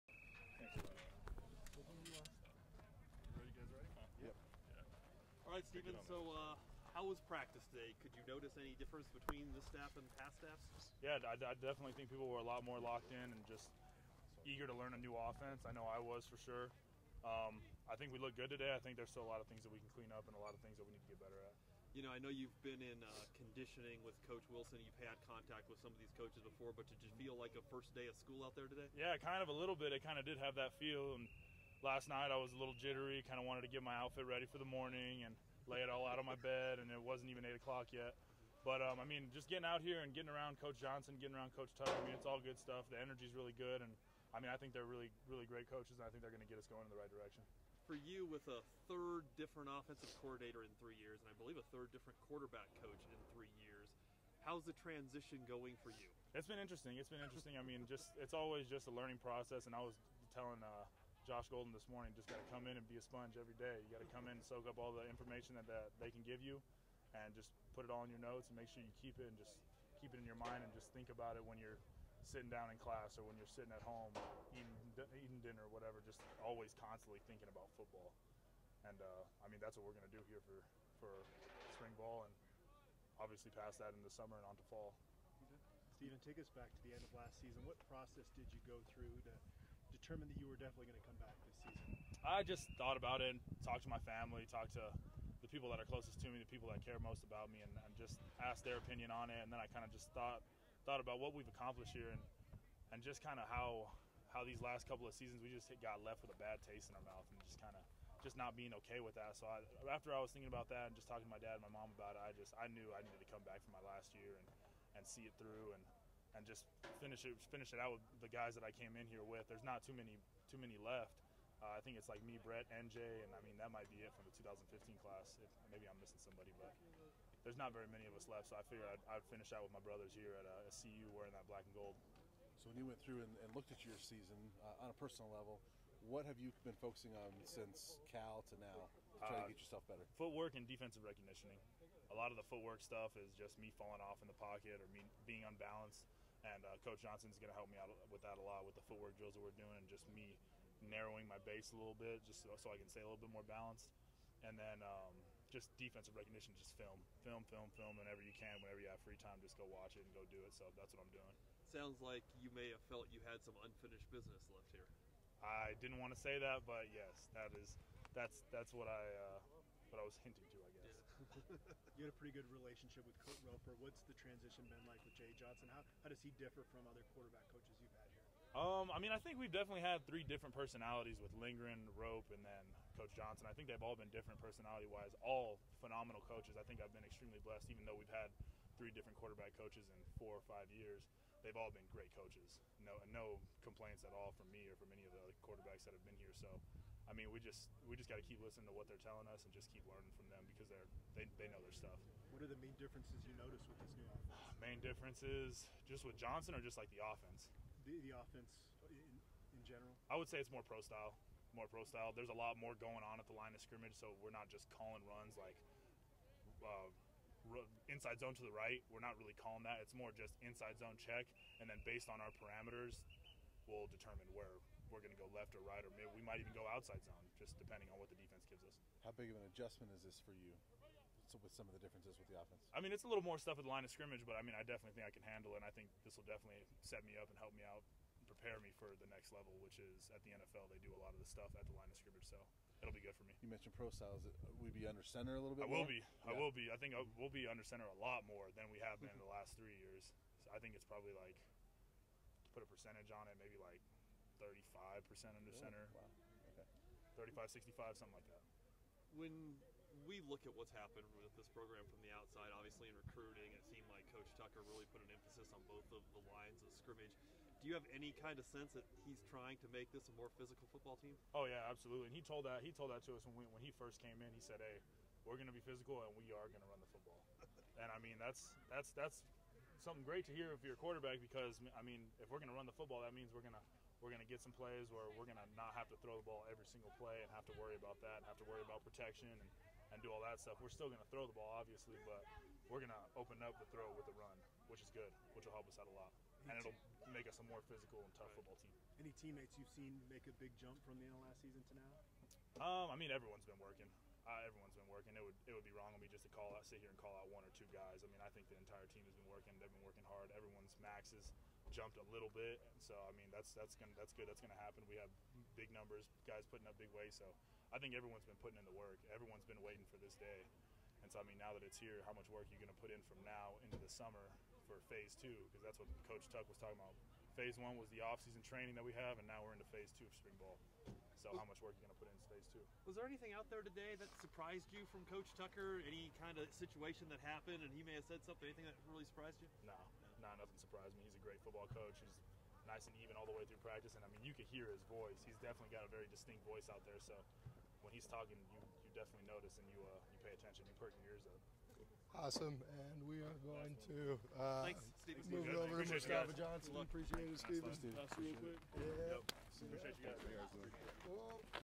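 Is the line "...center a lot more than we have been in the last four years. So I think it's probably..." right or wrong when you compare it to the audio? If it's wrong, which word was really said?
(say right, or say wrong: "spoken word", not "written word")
wrong: "three", not "four".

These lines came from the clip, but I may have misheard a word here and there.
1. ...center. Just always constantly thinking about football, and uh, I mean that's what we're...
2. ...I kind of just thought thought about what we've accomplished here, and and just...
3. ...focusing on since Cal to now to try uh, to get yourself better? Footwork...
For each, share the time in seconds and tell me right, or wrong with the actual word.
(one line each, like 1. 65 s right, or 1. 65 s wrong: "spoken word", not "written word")
1. 75 s wrong: "whatever", not "center"
2. 99 s right
3. 136 s right.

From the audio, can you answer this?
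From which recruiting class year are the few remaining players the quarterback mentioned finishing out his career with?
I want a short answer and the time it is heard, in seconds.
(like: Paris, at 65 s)
2015, at 124 s.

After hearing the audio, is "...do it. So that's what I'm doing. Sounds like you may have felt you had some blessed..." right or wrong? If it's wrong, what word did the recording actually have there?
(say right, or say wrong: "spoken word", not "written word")
wrong: "unfinished", not "blessed".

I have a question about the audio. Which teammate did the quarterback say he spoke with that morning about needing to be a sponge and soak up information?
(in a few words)
Josh Golden.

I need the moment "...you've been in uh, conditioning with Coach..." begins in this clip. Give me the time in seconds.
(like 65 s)
22 s.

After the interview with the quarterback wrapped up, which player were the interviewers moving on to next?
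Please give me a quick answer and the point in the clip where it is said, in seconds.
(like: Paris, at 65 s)
Mustafa Johnson, at 355 s.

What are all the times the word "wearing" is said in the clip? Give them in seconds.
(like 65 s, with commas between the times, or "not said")
131 s.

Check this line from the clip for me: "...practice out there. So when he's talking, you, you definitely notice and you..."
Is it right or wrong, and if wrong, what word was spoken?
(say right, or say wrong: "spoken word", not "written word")
wrong: "voice", not "practice".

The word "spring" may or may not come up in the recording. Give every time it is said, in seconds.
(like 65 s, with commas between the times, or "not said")
81 s, 330 s.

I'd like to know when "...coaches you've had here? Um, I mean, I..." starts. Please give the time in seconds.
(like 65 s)
177 s.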